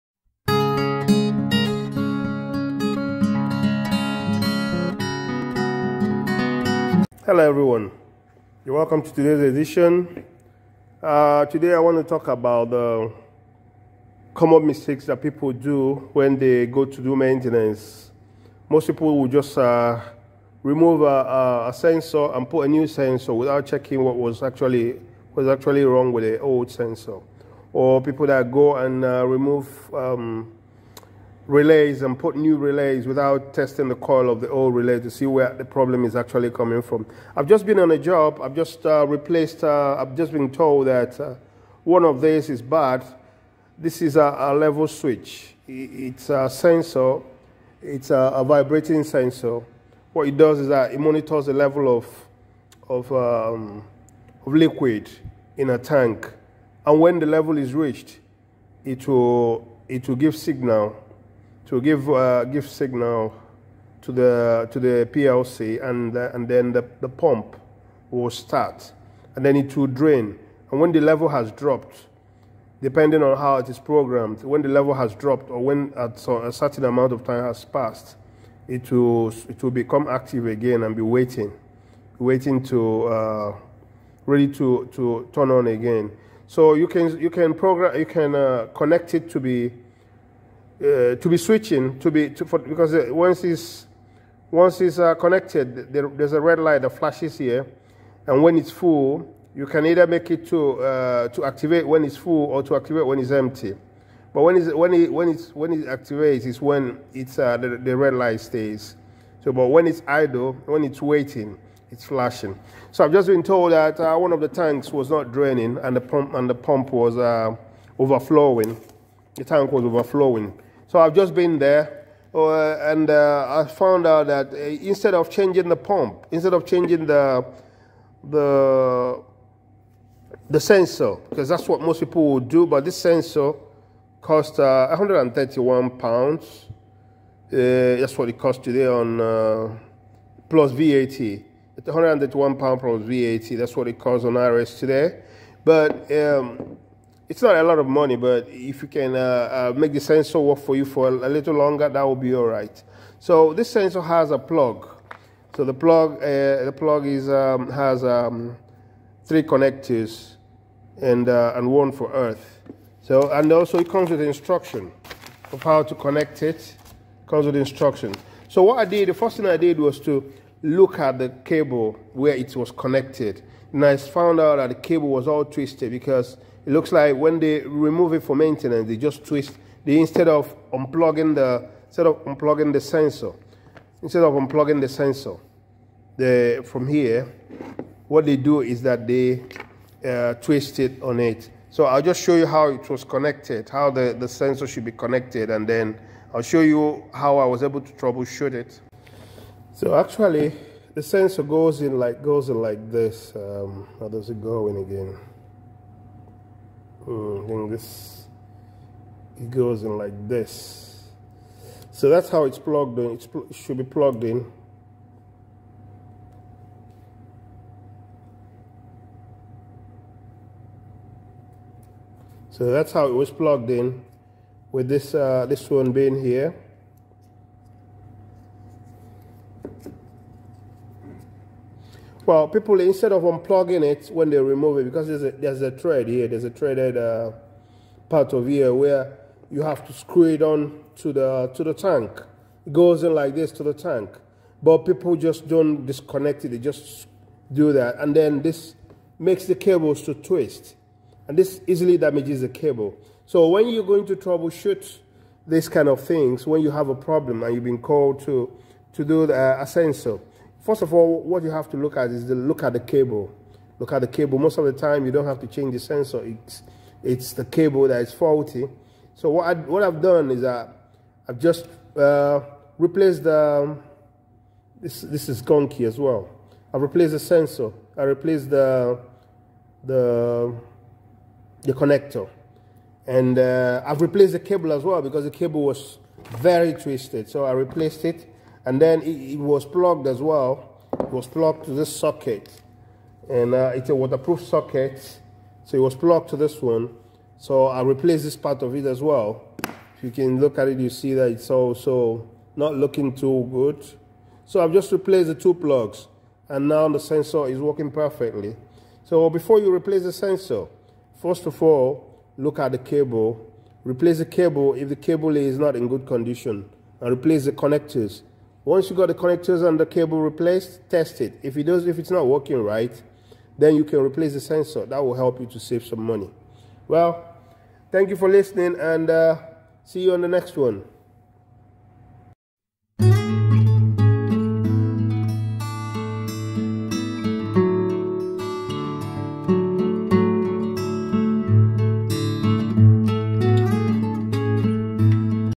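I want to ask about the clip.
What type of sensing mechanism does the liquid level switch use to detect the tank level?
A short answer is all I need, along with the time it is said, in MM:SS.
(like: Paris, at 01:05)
vibrating, at 00:48.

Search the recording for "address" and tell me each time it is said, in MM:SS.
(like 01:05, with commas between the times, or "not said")
not said.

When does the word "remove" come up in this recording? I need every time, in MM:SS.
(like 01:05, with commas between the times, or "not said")
00:20, 00:29, 02:57, 03:54.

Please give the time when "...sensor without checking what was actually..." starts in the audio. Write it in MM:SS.
00:22.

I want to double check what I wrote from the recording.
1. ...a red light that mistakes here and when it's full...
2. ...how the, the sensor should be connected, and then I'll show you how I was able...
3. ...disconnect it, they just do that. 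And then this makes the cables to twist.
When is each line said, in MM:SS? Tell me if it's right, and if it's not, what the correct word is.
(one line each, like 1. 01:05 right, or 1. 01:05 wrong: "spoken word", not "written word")
1. 01:36 wrong: "flashes", not "mistakes"
2. 03:13 right
3. 04:05 right.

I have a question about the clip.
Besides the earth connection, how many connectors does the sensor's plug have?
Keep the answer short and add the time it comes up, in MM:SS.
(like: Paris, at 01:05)
3, at 02:39.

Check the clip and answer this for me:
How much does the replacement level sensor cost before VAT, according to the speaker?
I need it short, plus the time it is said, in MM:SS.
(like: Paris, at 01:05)
131 pounds, at 02:14.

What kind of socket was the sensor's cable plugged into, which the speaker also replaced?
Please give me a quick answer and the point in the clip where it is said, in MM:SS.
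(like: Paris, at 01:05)
waterproof socket, at 04:53.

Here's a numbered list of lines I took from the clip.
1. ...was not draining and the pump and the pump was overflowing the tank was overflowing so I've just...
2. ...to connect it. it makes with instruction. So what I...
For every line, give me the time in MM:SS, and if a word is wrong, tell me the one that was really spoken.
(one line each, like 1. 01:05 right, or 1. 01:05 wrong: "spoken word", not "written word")
1. 01:54 right
2. 02:45 wrong: "comes", not "makes".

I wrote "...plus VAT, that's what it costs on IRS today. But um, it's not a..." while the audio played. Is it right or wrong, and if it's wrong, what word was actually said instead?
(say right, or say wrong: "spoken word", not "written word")
right.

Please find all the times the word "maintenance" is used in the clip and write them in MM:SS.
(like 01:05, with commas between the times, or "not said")
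00:17, 02:58.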